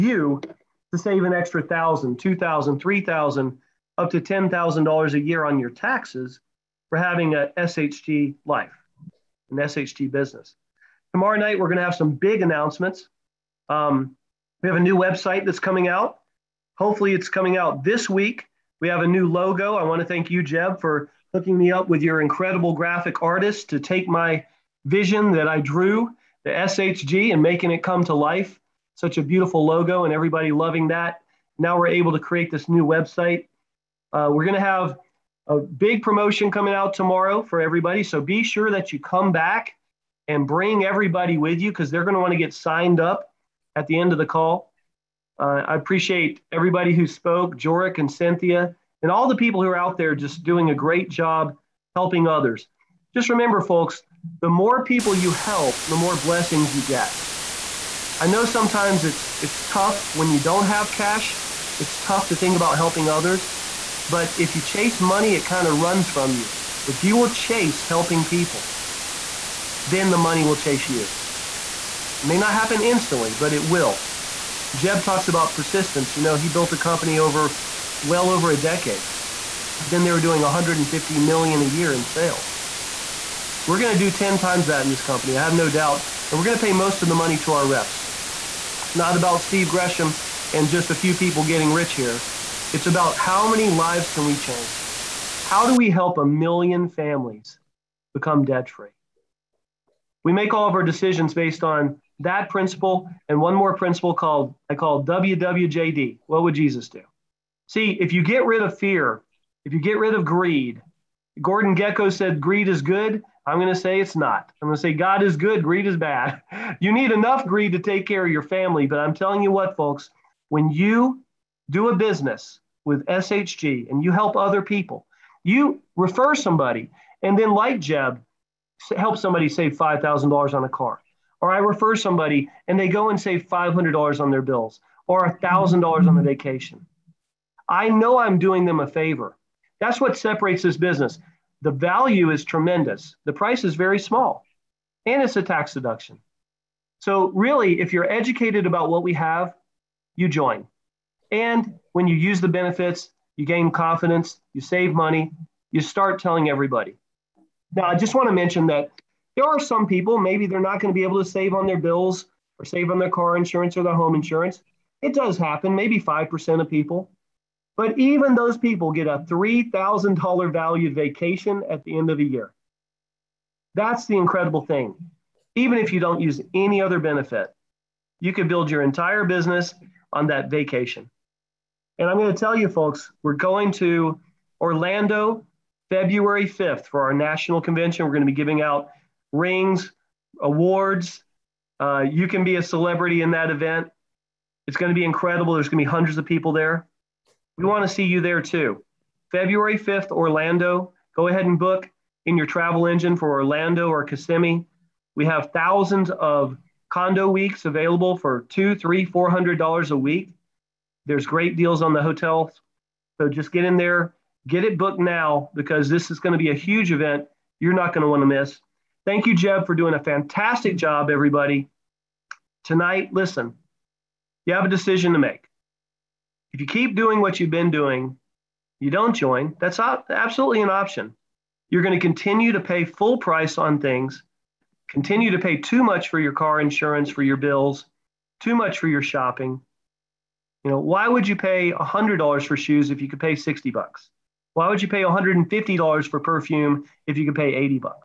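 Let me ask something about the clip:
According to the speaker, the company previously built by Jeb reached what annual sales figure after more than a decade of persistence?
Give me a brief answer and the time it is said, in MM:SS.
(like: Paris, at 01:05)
$150 million, at 01:20.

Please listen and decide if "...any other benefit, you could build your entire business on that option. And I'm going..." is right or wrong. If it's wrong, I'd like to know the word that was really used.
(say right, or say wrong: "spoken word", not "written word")
wrong: "vacation", not "option".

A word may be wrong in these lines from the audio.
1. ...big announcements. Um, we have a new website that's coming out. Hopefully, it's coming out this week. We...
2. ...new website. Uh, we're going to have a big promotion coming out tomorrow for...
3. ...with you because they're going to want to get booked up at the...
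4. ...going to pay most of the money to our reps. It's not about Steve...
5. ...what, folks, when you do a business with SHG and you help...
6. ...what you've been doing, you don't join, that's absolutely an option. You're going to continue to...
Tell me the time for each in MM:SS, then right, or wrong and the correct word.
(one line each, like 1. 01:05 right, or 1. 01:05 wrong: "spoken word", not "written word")
1. 00:12 right
2. 00:32 right
3. 00:41 wrong: "signed", not "booked"
4. 01:26 right
5. 01:59 right
6. 03:47 right.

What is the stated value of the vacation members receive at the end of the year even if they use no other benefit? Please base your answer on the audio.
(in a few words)
$3,000.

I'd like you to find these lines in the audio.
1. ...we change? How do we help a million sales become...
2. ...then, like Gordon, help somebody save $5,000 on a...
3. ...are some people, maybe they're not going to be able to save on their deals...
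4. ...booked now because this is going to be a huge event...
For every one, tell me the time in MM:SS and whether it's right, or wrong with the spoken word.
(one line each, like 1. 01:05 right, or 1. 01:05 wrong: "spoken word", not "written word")
1. 01:34 wrong: "families", not "sales"
2. 02:07 wrong: "Jeb", not "Gordon"
3. 02:39 wrong: "bills", not "deals"
4. 03:34 right.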